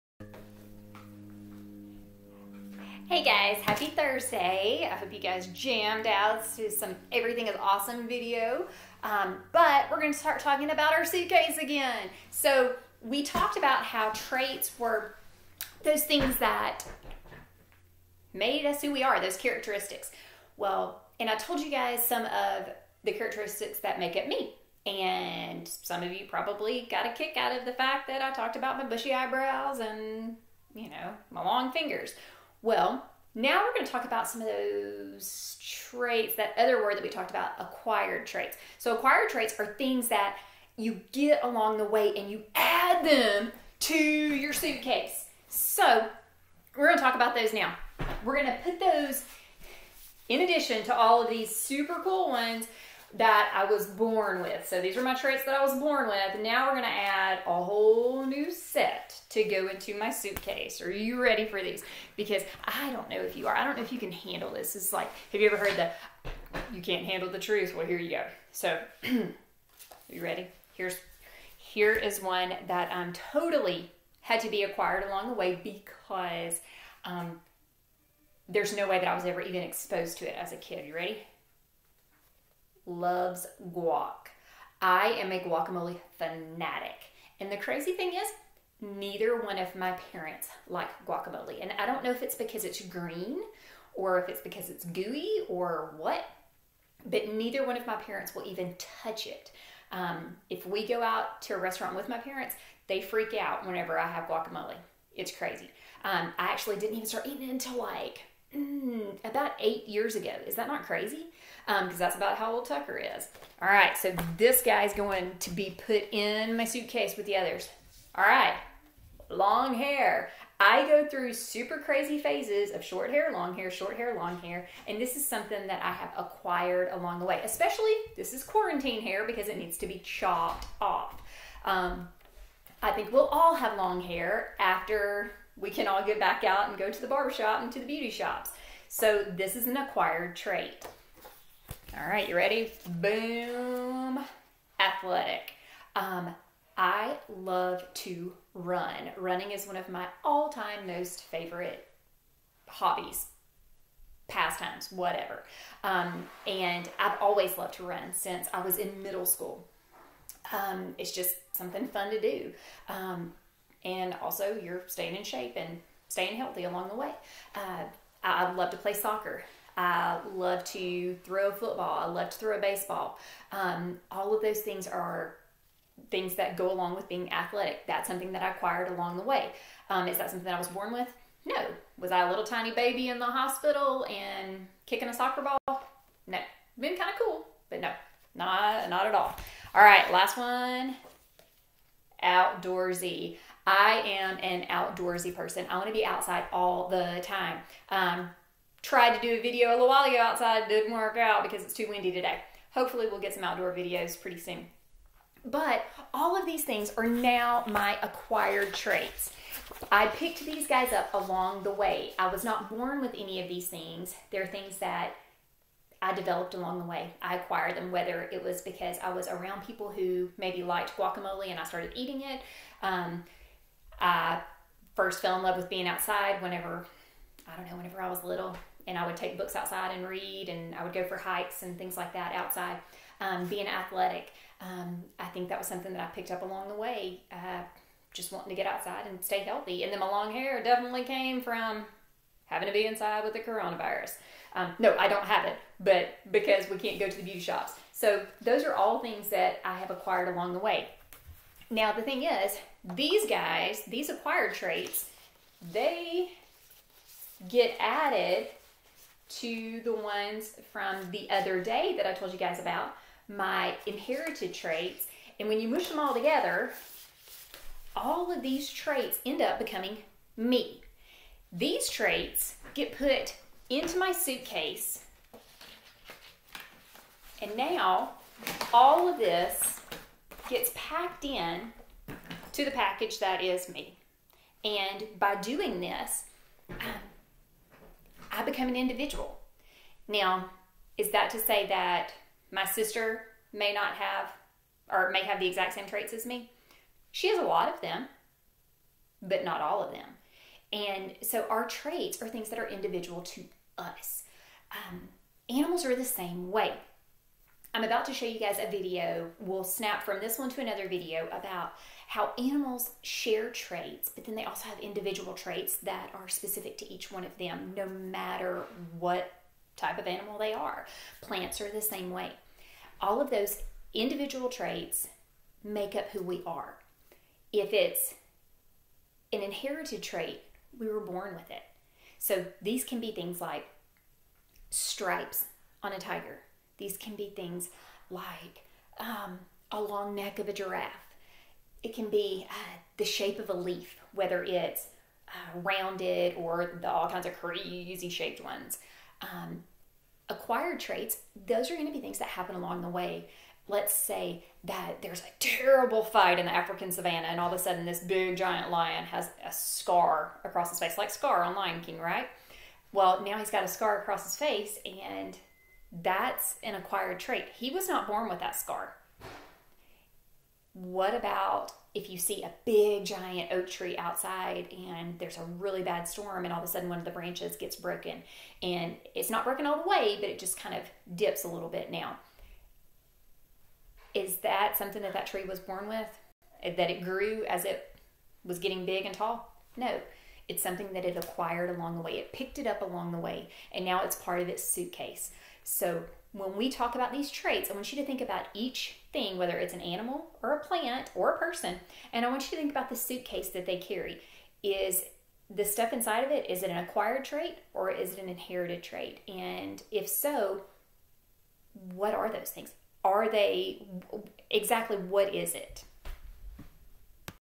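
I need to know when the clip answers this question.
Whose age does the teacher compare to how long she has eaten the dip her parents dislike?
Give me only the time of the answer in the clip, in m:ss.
1:52.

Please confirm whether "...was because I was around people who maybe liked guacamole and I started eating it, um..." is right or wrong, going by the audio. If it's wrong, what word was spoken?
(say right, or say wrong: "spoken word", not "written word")
right.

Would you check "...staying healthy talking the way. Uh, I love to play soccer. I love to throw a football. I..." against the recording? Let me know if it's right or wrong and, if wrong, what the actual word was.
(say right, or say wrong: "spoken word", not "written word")
wrong: "along", not "talking".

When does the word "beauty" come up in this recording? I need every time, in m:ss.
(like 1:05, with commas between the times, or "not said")
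2:17, 4:07.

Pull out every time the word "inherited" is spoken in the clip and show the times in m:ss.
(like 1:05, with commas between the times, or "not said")
4:23, 5:29, 6:48.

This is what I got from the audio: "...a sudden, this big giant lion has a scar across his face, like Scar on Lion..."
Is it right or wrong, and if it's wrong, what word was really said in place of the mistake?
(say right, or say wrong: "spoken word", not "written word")
right.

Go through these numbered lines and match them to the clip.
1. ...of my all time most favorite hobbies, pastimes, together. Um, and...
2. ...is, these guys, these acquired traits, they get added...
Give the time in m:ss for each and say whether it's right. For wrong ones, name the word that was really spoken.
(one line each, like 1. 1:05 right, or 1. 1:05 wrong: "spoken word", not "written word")
1. 2:29 wrong: "whatever", not "together"
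2. 4:12 right.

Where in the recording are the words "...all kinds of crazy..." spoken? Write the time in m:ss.
5:46.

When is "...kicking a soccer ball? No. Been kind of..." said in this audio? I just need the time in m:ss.
3:04.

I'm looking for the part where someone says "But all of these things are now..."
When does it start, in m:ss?
3:25.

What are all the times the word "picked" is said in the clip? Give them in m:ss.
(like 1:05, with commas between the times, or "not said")
3:30, 3:56, 6:32.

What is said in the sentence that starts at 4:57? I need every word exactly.
She has a lot of them, but not all of them.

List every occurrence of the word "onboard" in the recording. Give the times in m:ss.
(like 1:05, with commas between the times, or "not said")
not said.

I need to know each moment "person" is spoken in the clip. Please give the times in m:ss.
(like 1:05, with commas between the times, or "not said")
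3:15, 6:41.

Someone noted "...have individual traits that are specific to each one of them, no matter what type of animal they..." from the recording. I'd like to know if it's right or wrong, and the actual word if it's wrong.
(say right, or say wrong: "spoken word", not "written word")
right.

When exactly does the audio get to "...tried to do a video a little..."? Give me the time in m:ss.
3:18.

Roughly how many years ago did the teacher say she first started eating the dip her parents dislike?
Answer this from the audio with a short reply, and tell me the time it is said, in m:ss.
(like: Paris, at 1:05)
8, at 1:49.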